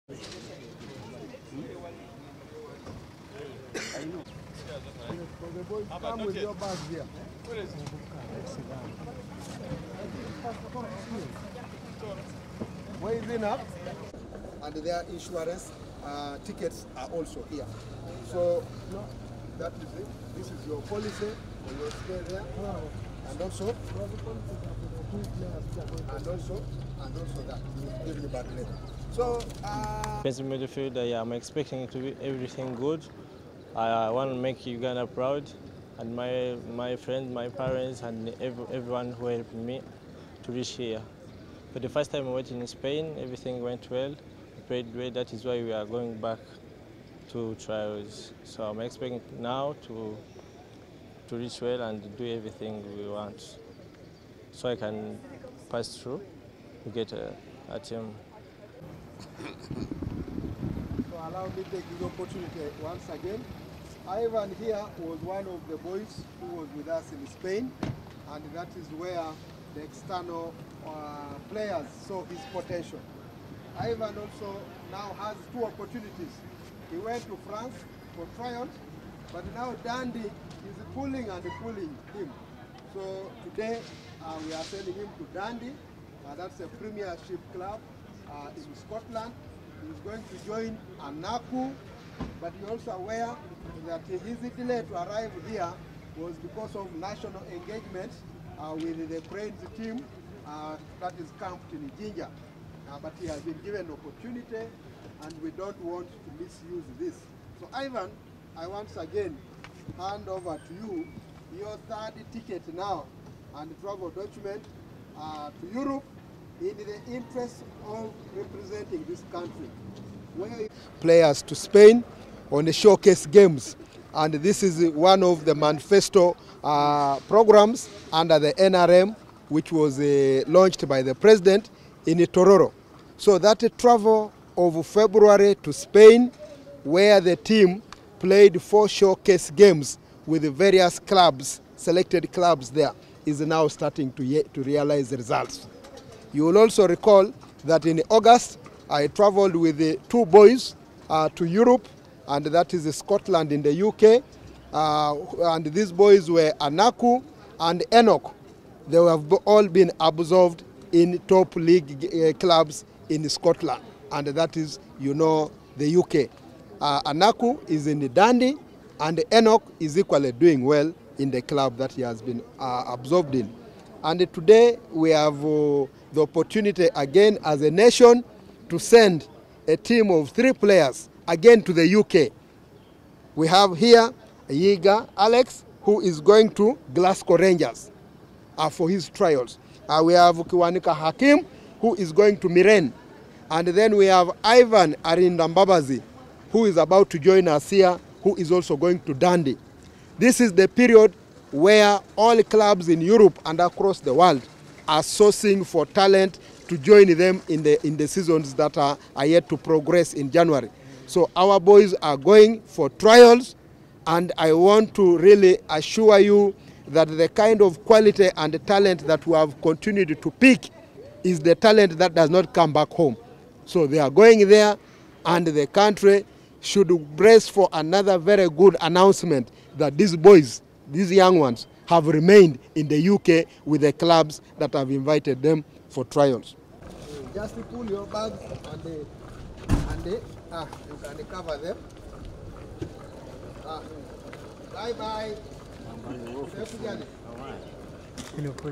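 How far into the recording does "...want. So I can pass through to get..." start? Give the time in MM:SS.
00:53.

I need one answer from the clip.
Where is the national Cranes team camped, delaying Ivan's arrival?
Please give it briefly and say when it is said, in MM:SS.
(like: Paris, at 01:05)
Jinja, at 01:41.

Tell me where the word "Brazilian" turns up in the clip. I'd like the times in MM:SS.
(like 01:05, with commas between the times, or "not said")
not said.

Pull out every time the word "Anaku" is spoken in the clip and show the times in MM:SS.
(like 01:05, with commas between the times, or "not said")
02:36, 02:47.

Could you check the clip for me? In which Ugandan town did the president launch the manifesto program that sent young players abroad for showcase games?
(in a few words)
Tororo.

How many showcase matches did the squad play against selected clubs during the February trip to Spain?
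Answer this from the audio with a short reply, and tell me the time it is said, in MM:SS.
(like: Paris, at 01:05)
4, at 02:18.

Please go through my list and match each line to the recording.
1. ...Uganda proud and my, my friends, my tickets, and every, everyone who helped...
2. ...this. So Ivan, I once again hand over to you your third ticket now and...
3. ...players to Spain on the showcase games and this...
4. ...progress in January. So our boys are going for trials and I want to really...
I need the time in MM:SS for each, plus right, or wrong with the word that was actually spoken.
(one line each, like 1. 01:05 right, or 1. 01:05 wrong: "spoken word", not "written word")
1. 00:34 wrong: "parents", not "tickets"
2. 01:46 right
3. 02:00 right
4. 03:29 right.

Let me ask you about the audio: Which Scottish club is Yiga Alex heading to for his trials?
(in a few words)
Glasgow Rangers.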